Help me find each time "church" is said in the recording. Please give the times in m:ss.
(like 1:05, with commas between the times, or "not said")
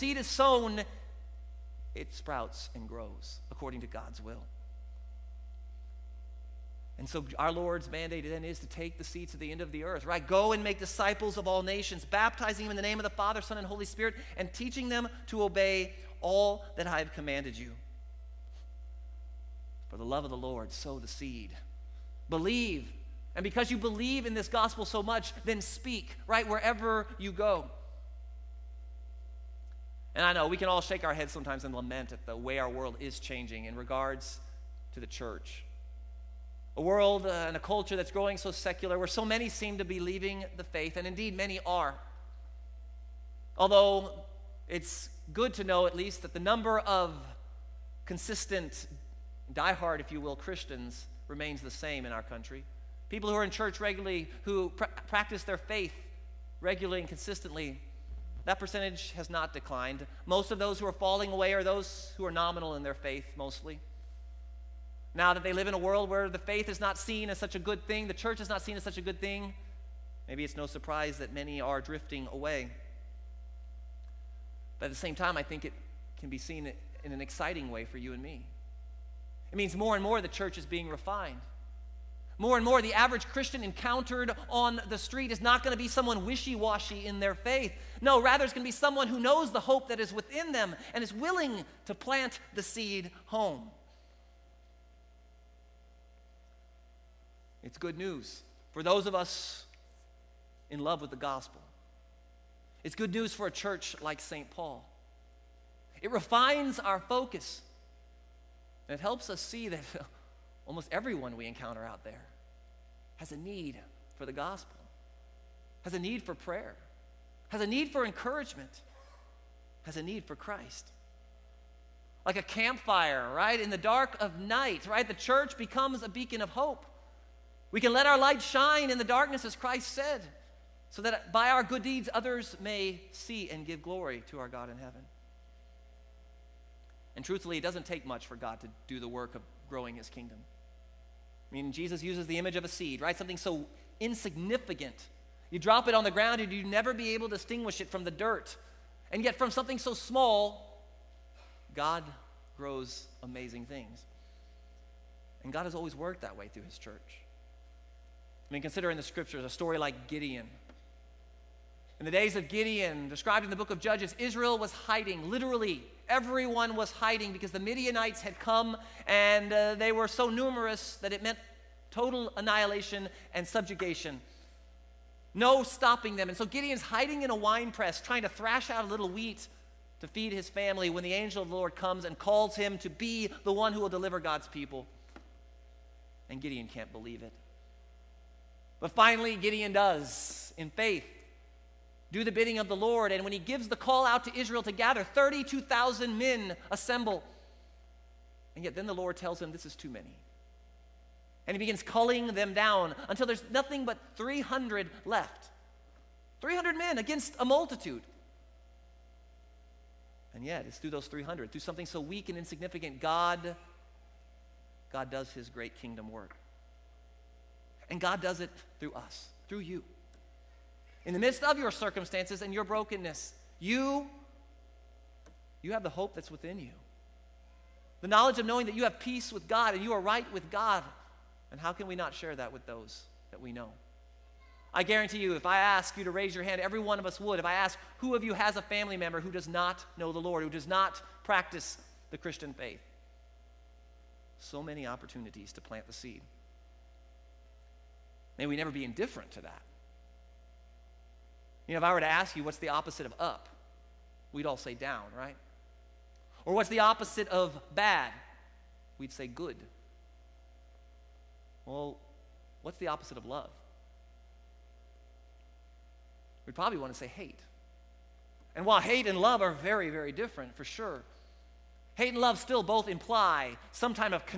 0:35, 0:53, 1:08, 1:20, 1:43, 2:05, 2:36.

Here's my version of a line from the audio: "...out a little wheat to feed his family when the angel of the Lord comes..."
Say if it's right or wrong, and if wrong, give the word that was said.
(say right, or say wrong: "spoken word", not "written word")
right.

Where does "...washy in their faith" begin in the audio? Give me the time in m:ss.
1:26.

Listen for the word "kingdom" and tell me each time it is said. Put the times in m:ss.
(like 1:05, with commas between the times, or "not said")
2:20, 3:35.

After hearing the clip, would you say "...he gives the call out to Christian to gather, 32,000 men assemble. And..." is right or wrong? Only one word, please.
wrong.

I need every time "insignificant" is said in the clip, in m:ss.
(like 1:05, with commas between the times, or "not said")
2:23, 3:32.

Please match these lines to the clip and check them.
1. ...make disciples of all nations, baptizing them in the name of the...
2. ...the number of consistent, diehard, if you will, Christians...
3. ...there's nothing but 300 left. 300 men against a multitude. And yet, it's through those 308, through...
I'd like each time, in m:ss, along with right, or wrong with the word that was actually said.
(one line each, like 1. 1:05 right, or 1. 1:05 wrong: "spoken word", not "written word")
1. 0:10 right
2. 0:46 right
3. 3:23 wrong: "300", not "308".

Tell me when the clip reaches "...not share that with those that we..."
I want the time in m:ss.
3:51.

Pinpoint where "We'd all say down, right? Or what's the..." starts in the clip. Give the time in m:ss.
4:14.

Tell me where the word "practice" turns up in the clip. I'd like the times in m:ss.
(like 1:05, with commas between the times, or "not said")
0:55, 4:01.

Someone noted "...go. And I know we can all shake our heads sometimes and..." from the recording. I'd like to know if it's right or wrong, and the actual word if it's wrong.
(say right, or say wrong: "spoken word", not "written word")
right.